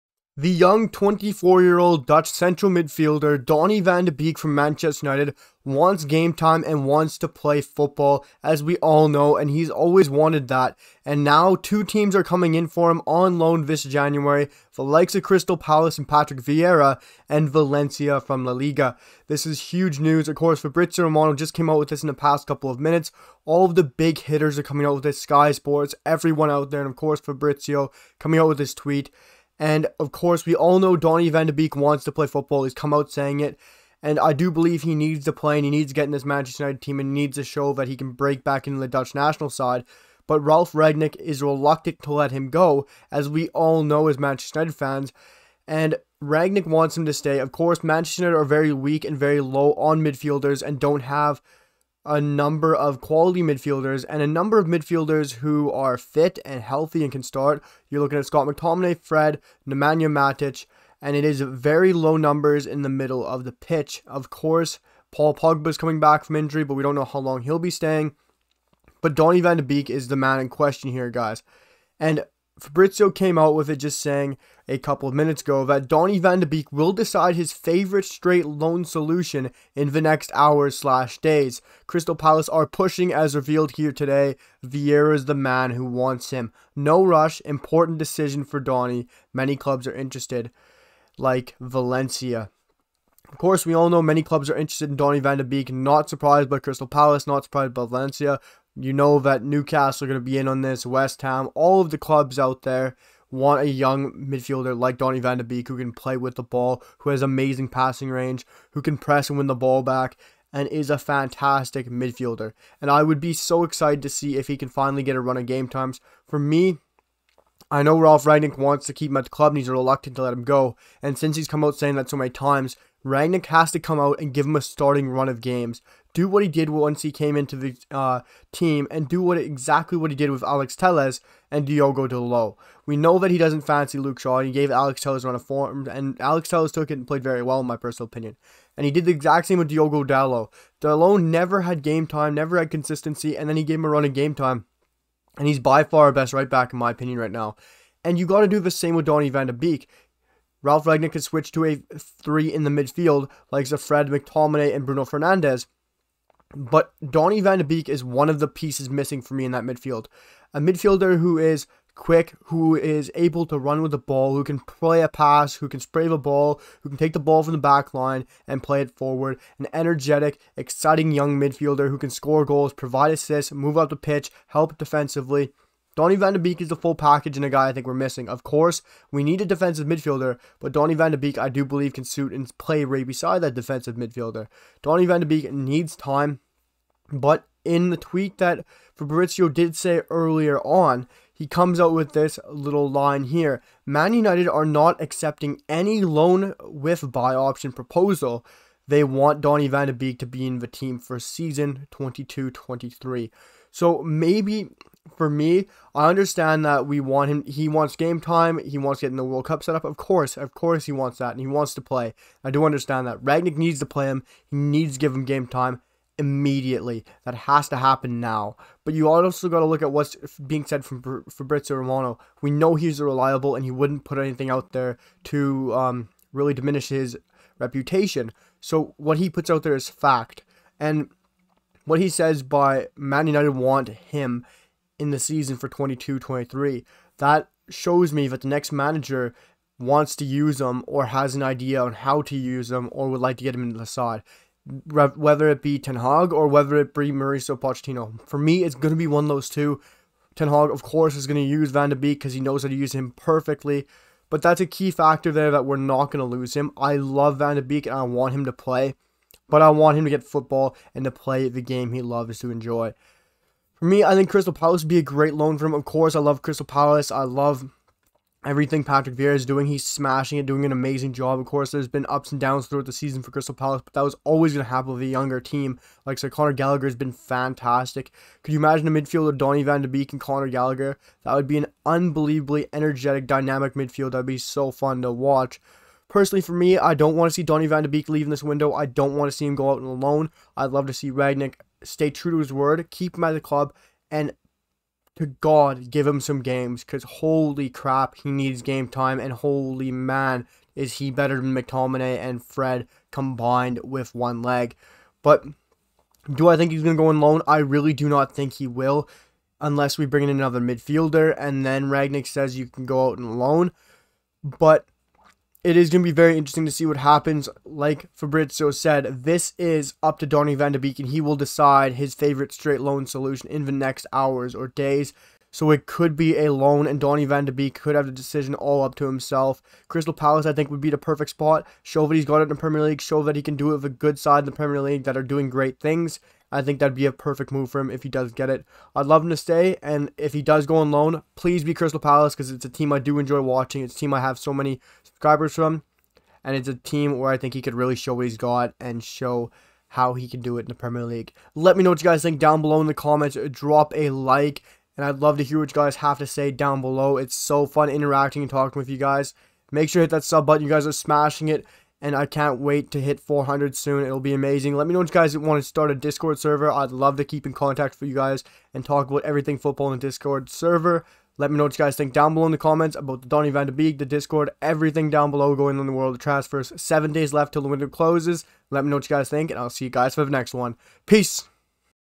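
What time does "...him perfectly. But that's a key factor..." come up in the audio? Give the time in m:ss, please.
4:12.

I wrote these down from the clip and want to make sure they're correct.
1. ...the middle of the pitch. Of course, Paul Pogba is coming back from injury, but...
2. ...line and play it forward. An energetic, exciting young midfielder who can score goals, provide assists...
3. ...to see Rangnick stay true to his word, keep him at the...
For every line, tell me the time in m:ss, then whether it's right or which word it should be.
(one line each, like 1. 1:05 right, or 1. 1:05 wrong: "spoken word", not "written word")
1. 1:02 right
2. 2:47 right
3. 4:50 right.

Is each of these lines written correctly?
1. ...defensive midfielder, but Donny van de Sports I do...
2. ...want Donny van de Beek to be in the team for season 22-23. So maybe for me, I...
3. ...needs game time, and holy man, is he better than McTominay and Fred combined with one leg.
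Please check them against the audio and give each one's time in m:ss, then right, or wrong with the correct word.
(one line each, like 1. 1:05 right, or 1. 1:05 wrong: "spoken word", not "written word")
1. 2:59 wrong: "Beek", not "Sports"
2. 3:19 right
3. 4:58 right.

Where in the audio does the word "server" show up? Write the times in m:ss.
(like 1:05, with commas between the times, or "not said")
6:06, 6:10.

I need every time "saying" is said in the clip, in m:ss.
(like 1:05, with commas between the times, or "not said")
0:33, 1:13, 2:01.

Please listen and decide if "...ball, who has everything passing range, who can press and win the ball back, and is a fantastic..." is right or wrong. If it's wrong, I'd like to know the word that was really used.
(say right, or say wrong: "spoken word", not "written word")
wrong: "amazing", not "everything".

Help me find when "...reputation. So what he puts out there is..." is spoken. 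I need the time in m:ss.
3:47.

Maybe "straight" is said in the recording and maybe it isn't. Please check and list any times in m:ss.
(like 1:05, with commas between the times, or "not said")
1:18, 5:22.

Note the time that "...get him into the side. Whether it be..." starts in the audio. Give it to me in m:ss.
4:03.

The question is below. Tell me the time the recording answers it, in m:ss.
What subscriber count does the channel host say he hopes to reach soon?
6:03.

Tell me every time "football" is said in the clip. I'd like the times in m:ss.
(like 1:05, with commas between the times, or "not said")
0:07, 0:32, 4:20, 6:09.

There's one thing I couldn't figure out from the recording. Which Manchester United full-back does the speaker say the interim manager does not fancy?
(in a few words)
Luke Shaw.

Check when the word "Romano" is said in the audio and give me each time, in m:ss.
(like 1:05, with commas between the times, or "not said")
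0:21, 3:41.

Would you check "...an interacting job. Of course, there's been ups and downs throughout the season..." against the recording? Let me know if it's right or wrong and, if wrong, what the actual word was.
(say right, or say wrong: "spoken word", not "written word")
wrong: "amazing", not "interacting".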